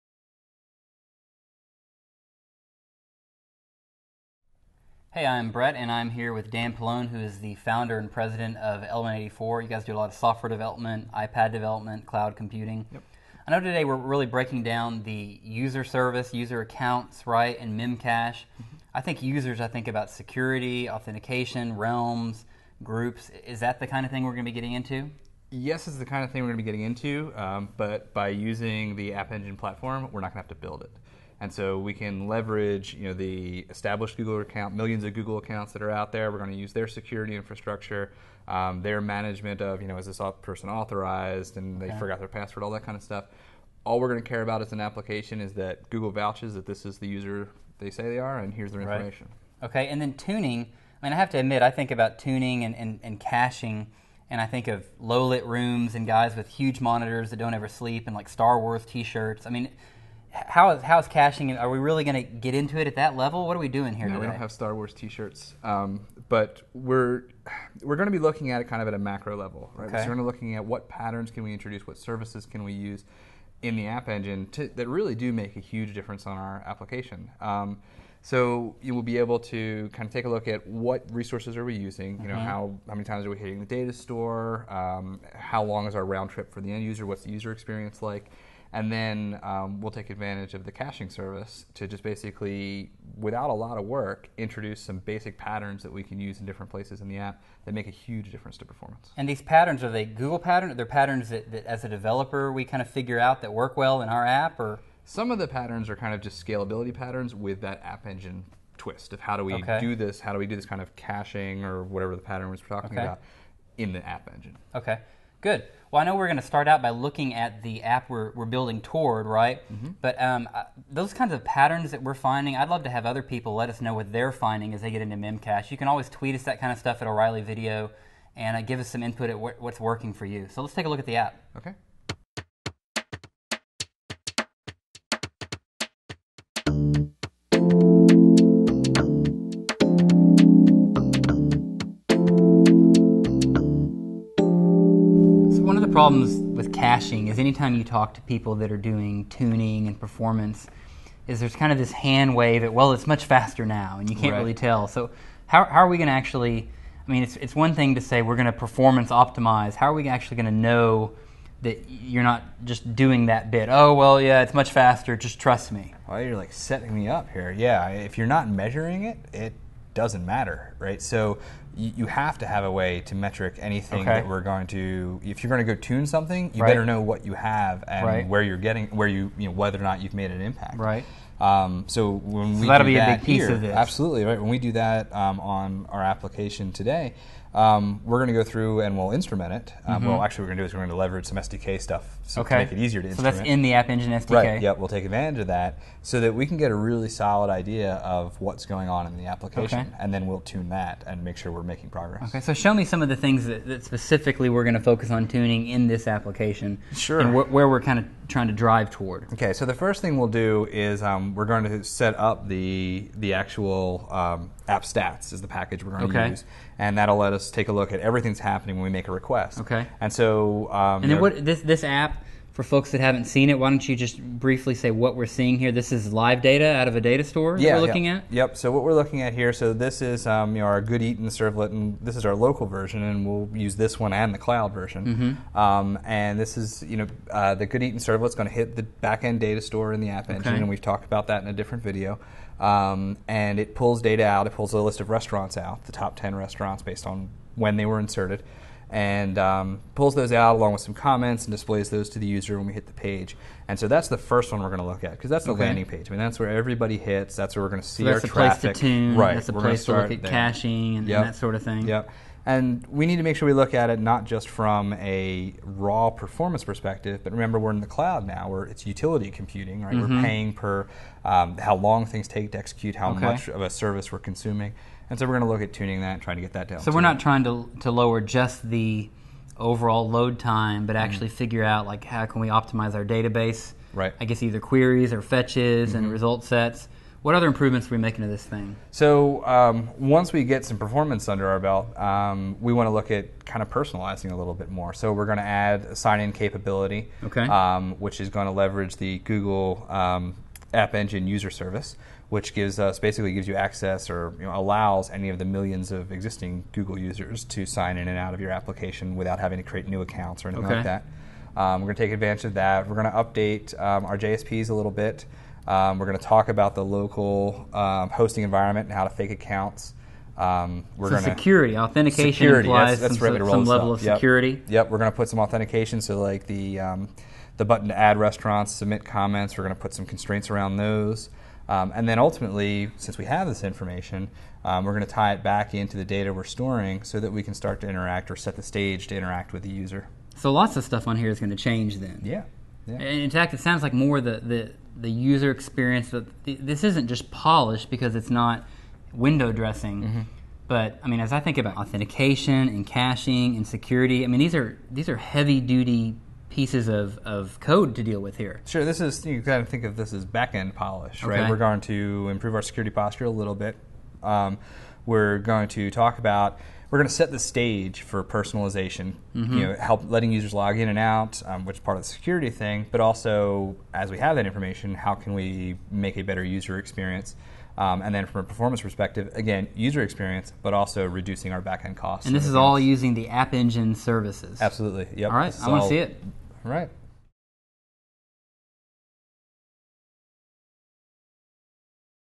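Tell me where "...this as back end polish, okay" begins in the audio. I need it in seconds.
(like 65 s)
359 s.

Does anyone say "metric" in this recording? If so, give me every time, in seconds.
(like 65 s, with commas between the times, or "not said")
173 s.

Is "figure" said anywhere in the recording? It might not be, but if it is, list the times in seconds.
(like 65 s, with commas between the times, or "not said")
102 s, 281 s.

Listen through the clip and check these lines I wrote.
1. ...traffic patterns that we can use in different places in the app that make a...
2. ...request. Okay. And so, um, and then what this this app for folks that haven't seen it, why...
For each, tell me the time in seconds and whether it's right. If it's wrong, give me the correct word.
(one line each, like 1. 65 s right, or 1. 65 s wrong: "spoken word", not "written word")
1. 94 s wrong: "basic", not "traffic"
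2. 219 s right.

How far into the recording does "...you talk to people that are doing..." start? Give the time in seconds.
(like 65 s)
147 s.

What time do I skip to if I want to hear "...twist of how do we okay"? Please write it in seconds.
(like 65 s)
108 s.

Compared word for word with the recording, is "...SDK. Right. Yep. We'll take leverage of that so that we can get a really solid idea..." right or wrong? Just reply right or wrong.
wrong.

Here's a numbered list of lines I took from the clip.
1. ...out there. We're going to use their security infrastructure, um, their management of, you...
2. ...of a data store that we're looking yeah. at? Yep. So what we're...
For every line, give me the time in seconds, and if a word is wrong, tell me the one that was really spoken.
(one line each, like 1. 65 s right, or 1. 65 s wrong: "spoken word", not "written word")
1. 35 s right
2. 226 s right.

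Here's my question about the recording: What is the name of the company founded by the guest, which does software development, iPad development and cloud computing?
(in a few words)
Element84.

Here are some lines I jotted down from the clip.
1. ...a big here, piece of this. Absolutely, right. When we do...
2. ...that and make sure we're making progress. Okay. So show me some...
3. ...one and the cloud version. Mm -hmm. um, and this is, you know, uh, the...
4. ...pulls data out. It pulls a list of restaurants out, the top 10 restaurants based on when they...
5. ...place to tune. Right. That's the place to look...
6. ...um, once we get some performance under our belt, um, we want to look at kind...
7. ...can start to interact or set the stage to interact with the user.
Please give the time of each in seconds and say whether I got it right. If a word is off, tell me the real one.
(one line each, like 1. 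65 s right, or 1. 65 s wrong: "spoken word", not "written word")
1. 183 s right
2. 200 s right
3. 234 s right
4. 243 s right
5. 258 s right
6. 289 s right
7. 337 s right.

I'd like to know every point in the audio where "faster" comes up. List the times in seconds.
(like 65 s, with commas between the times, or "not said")
153 s, 164 s.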